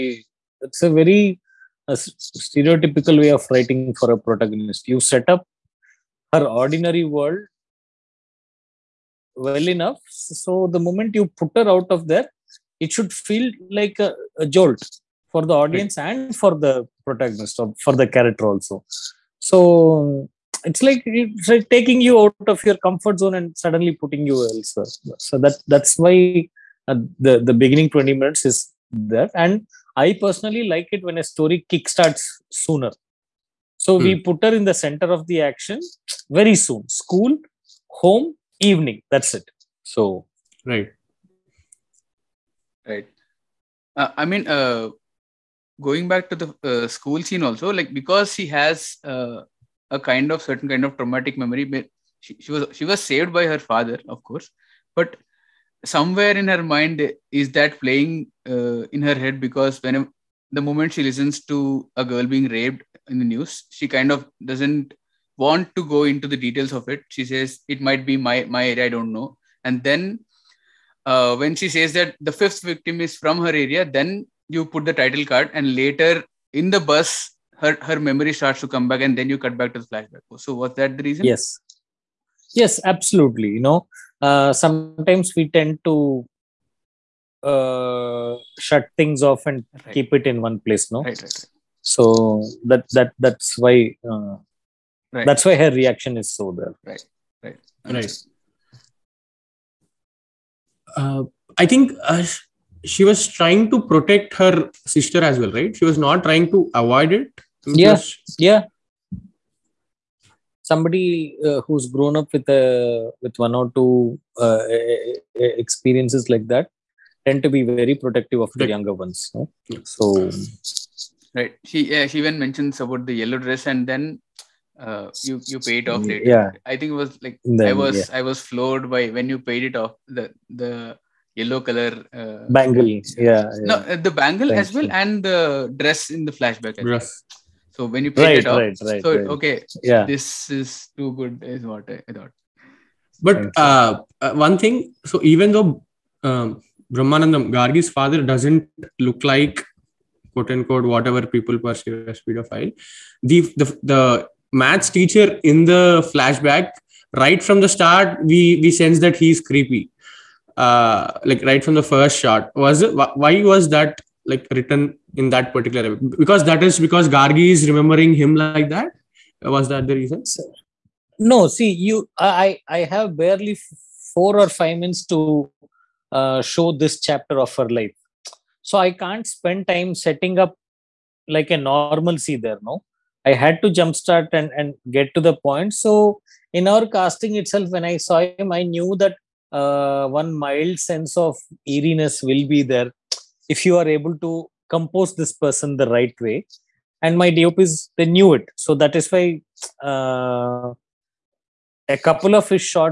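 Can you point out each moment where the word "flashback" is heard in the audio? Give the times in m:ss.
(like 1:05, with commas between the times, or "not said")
1:19, 2:16, 2:36.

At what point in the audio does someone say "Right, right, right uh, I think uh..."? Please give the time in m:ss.
1:36.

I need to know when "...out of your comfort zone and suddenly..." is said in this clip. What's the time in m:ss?
0:22.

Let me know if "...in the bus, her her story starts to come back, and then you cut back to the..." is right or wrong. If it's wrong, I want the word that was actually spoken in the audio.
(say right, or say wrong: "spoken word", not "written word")
wrong: "memory", not "story".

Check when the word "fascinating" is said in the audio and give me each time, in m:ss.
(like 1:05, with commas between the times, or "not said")
not said.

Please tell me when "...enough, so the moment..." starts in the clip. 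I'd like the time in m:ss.
0:09.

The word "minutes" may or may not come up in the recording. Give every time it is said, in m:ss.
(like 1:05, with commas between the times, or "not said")
0:28, 2:54.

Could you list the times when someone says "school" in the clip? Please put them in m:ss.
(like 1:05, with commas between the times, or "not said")
0:37, 0:46.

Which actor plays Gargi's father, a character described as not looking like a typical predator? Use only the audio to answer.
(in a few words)
Brahmanandam.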